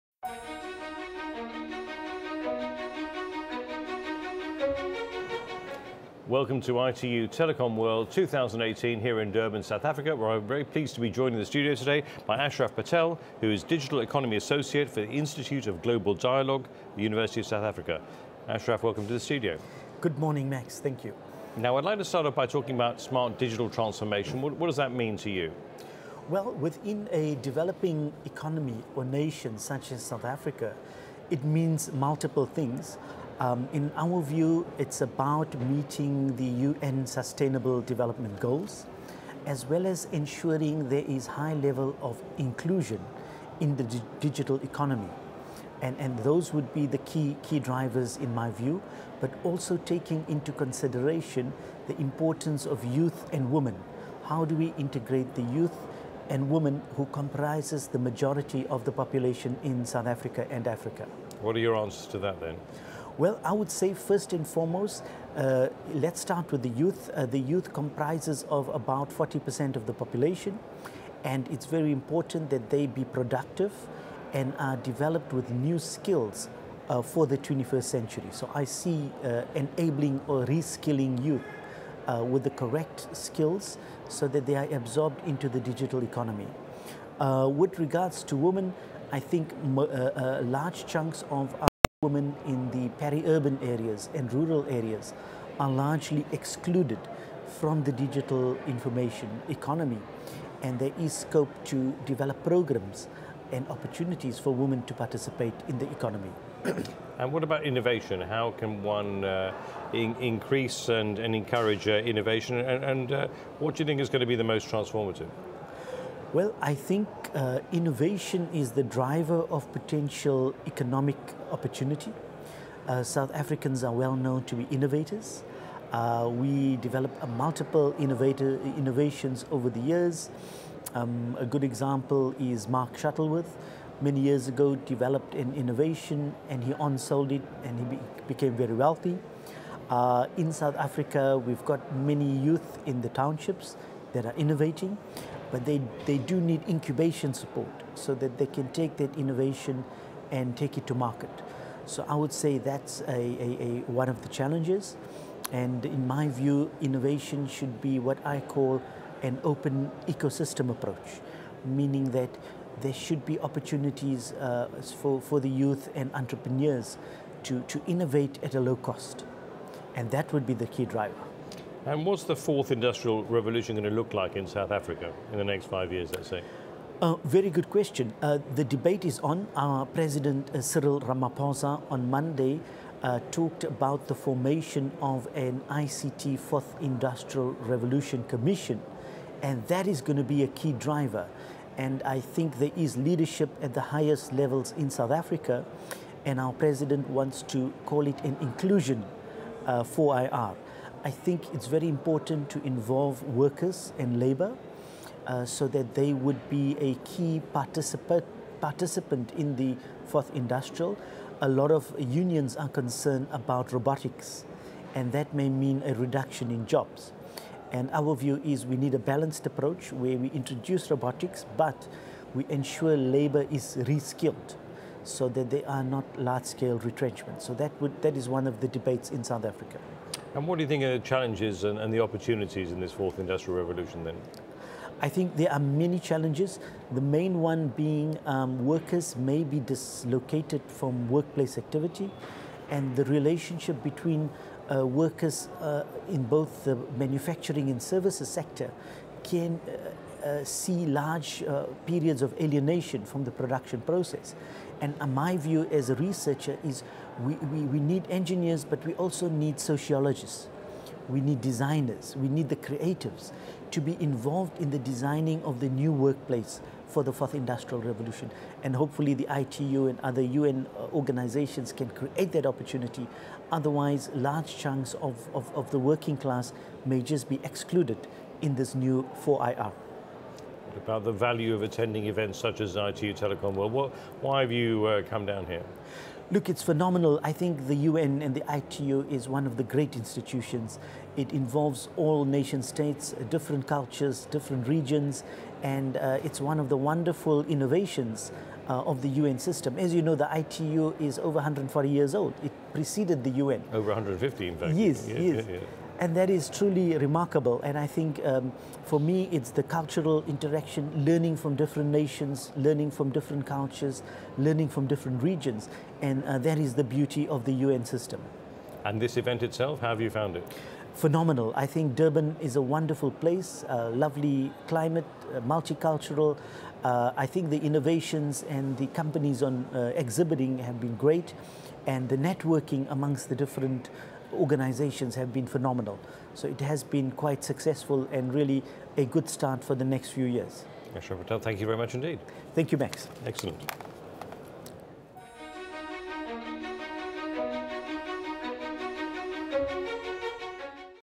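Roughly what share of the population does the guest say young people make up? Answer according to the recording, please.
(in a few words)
40%.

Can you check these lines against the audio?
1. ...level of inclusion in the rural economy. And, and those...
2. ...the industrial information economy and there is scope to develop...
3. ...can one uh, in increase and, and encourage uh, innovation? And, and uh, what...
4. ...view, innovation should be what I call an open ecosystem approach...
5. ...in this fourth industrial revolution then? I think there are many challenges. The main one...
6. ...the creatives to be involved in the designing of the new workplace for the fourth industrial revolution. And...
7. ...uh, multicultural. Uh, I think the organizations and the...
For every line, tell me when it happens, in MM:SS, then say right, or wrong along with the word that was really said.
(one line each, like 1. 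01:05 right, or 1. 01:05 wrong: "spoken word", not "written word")
1. 00:41 wrong: "digital", not "rural"
2. 01:37 wrong: "digital", not "industrial"
3. 01:48 right
4. 02:36 right
5. 03:52 right
6. 04:22 right
7. 05:25 wrong: "innovations", not "organizations".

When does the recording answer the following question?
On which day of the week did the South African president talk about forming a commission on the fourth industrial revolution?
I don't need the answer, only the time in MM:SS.
03:02.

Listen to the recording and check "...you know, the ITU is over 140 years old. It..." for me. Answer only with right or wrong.
right.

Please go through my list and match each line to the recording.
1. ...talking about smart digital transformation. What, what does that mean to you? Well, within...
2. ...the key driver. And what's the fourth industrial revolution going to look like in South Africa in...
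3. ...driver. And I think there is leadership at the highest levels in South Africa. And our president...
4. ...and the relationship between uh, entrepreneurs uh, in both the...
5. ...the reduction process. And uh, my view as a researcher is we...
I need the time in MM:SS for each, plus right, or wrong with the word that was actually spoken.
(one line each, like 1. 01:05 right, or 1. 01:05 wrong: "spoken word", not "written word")
1. 00:22 right
2. 02:50 right
3. 03:10 right
4. 04:02 wrong: "workers", not "entrepreneurs"
5. 04:13 wrong: "production", not "reduction".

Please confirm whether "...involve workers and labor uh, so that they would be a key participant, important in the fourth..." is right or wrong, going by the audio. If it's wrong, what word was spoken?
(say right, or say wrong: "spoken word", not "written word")
wrong: "participant", not "important".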